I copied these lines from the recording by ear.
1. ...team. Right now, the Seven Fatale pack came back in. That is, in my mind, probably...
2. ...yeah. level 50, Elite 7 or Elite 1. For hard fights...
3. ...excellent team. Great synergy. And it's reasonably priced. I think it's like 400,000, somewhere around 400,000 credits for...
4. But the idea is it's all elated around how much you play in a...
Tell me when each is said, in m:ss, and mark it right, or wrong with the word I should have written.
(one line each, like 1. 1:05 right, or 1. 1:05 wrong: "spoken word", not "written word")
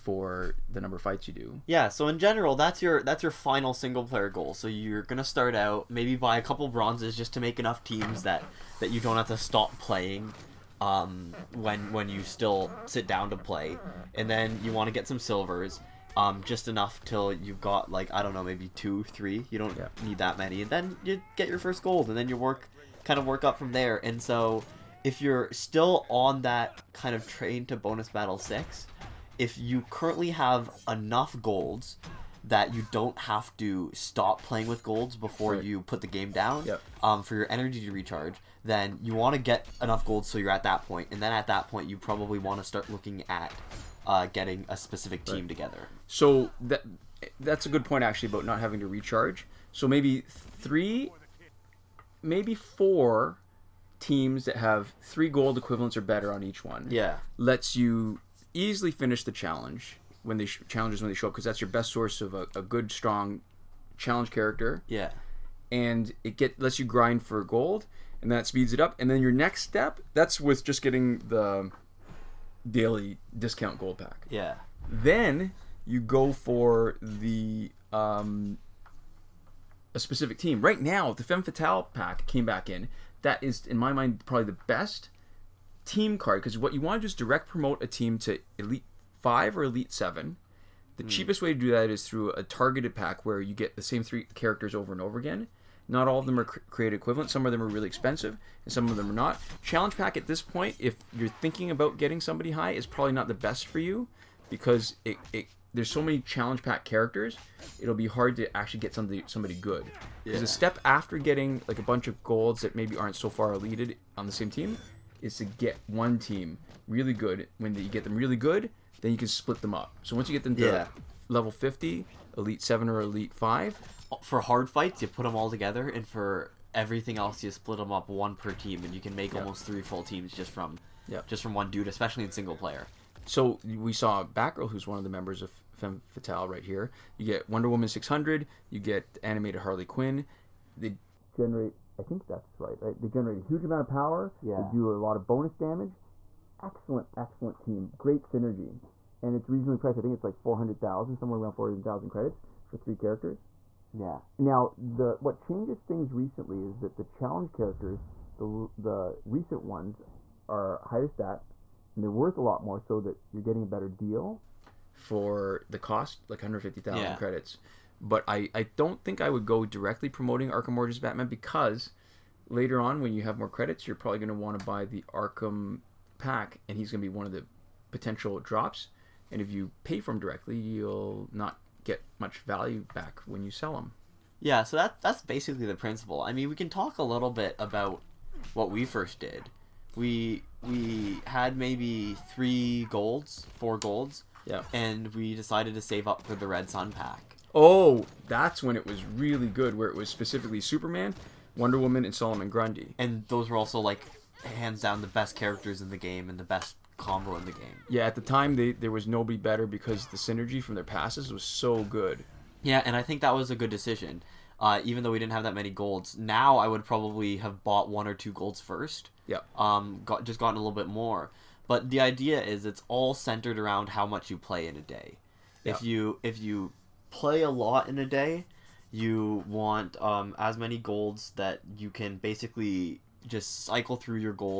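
1. 1:20 wrong: "Femme", not "Seven"
2. 2:00 wrong: "5", not "1"
3. 2:27 right
4. 3:41 wrong: "centered", not "elated".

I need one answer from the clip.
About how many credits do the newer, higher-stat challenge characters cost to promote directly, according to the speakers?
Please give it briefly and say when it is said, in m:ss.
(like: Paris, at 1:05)
150,000, at 2:46.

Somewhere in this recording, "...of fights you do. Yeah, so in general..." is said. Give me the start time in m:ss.
0:00.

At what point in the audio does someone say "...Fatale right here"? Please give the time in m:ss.
2:16.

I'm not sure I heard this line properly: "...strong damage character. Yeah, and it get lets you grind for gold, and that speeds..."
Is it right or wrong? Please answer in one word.
wrong.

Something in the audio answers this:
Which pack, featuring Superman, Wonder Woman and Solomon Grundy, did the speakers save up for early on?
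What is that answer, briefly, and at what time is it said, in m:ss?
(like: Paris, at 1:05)
Red Sun pack, at 3:16.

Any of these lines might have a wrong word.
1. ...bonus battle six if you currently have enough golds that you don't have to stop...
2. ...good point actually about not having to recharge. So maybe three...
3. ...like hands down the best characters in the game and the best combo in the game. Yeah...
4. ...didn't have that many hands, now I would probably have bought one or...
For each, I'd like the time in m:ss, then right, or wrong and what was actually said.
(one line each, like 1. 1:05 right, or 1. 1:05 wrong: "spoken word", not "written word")
1. 0:27 right
2. 0:47 right
3. 3:23 right
4. 3:35 wrong: "golds", not "hands".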